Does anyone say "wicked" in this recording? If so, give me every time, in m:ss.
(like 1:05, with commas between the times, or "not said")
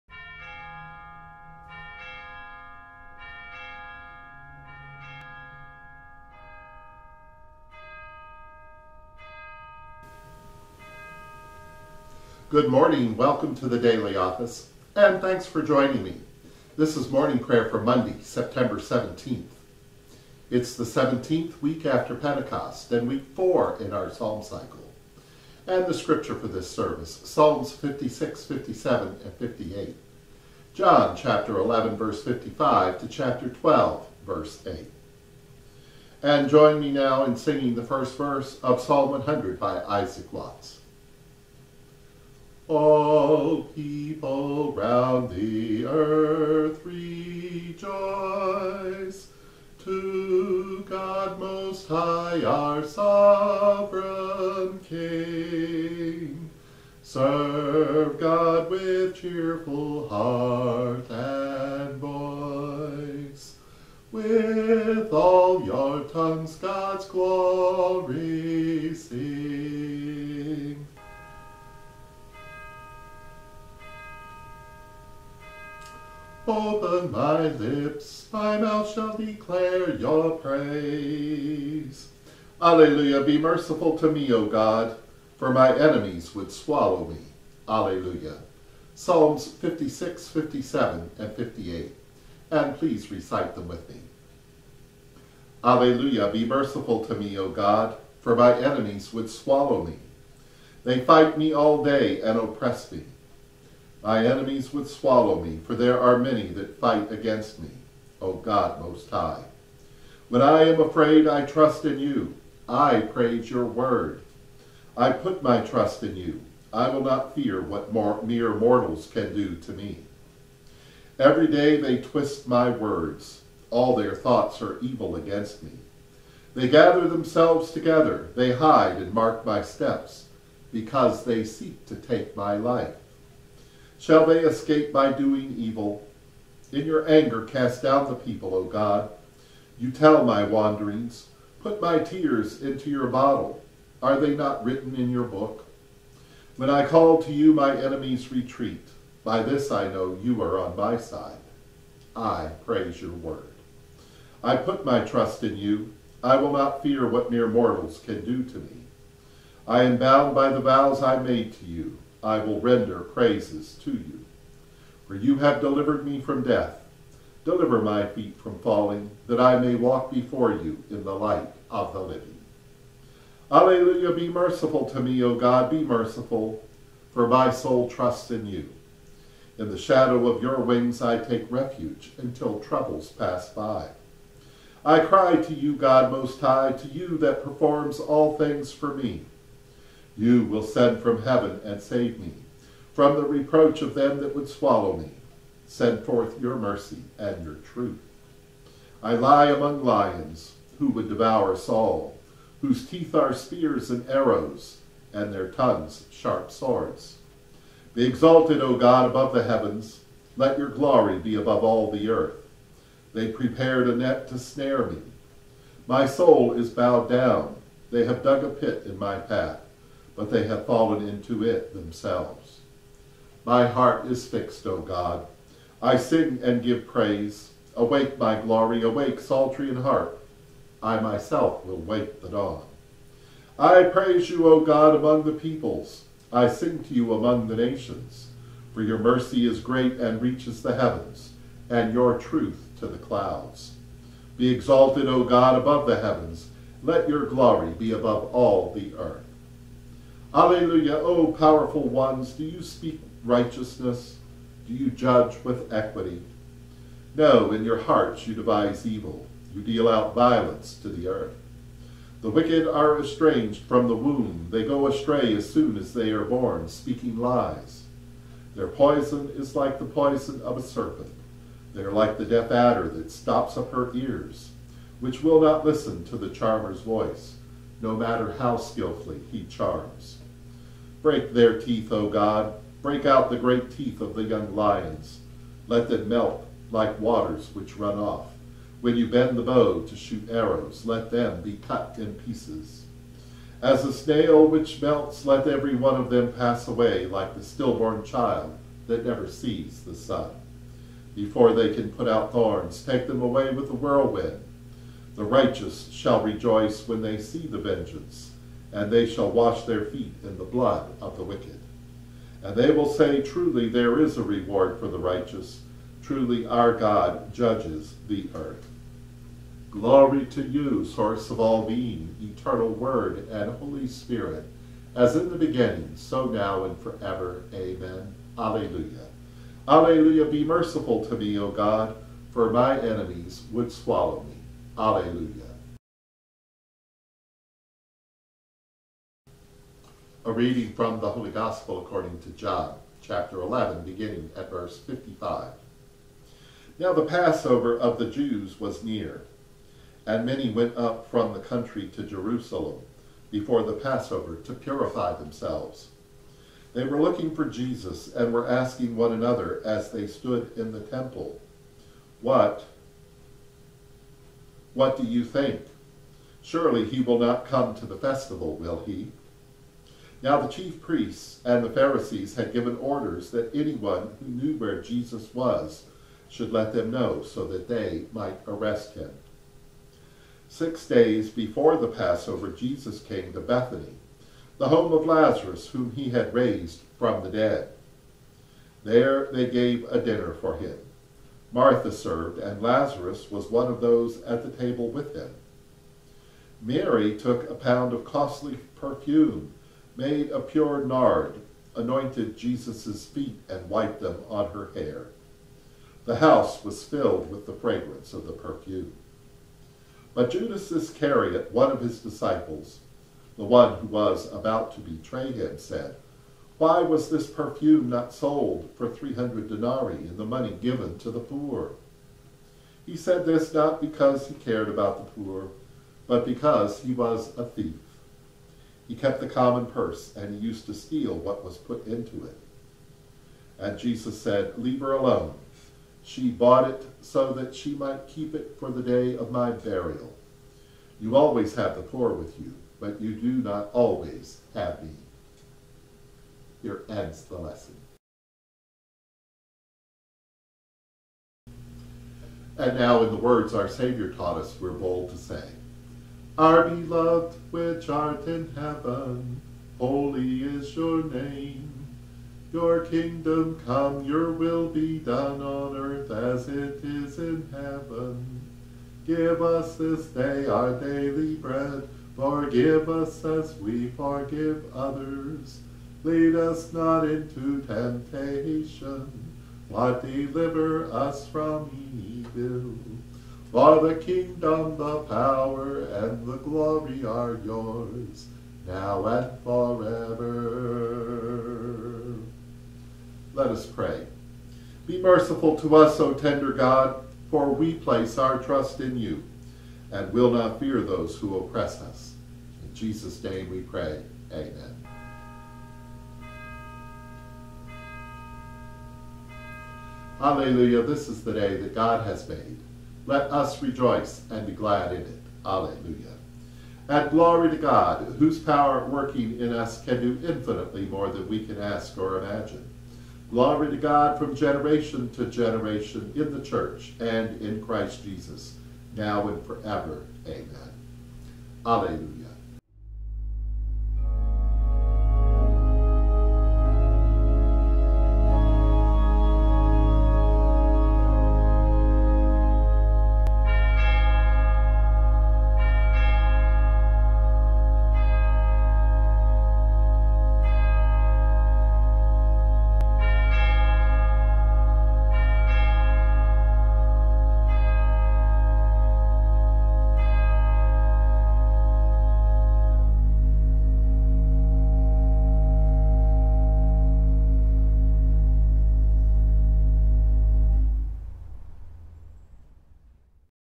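4:22, 5:11.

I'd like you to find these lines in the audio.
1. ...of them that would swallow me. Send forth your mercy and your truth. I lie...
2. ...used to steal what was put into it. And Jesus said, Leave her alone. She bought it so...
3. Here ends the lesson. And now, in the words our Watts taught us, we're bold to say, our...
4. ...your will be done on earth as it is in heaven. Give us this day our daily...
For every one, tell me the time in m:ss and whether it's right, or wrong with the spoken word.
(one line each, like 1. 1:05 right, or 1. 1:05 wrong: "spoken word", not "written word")
1. 3:13 right
2. 7:10 right
3. 7:26 wrong: "Savior", not "Watts"
4. 7:44 right.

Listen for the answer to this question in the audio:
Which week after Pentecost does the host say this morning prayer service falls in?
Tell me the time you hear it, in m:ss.
0:20.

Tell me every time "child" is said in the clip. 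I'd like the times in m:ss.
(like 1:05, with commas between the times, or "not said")
4:58.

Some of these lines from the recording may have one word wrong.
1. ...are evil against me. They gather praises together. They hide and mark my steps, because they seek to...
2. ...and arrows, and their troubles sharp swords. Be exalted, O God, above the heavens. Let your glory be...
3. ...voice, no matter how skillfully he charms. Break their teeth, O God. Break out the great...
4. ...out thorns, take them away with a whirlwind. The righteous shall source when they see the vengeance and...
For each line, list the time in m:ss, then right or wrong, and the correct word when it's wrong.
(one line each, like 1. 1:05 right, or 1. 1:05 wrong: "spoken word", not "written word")
1. 2:04 wrong: "themselves", not "praises"
2. 3:23 wrong: "tongues", not "troubles"
3. 4:36 right
4. 5:02 wrong: "rejoice", not "source".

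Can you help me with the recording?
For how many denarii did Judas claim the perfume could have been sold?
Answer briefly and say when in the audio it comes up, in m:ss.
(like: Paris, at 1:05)
300, at 6:58.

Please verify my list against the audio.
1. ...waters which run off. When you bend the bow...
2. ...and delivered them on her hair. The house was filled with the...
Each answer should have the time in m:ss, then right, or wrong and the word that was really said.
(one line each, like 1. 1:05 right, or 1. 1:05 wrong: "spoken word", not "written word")
1. 4:46 right
2. 6:43 wrong: "wiped", not "delivered".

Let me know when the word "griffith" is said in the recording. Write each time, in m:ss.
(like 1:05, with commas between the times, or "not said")
not said.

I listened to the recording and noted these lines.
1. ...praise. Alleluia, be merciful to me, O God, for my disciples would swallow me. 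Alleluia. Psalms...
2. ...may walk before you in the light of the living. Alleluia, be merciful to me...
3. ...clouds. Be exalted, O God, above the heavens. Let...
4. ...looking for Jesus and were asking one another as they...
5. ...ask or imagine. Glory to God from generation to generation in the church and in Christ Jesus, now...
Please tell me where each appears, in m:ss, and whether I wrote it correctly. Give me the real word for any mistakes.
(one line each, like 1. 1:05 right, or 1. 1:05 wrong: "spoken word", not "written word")
1. 1:20 wrong: "enemies", not "disciples"
2. 2:49 right
3. 4:02 right
4. 5:57 right
5. 8:41 right.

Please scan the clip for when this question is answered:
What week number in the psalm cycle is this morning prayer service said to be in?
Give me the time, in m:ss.
0:23.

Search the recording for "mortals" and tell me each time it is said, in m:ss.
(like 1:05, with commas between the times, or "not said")
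1:58, 2:37.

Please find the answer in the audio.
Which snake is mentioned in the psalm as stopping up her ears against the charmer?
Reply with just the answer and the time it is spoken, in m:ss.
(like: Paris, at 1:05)
deaf adder, at 4:32.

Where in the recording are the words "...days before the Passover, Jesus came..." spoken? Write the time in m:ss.
6:20.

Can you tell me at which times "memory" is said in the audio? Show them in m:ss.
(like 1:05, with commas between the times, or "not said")
not said.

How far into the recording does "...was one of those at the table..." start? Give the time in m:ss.
6:33.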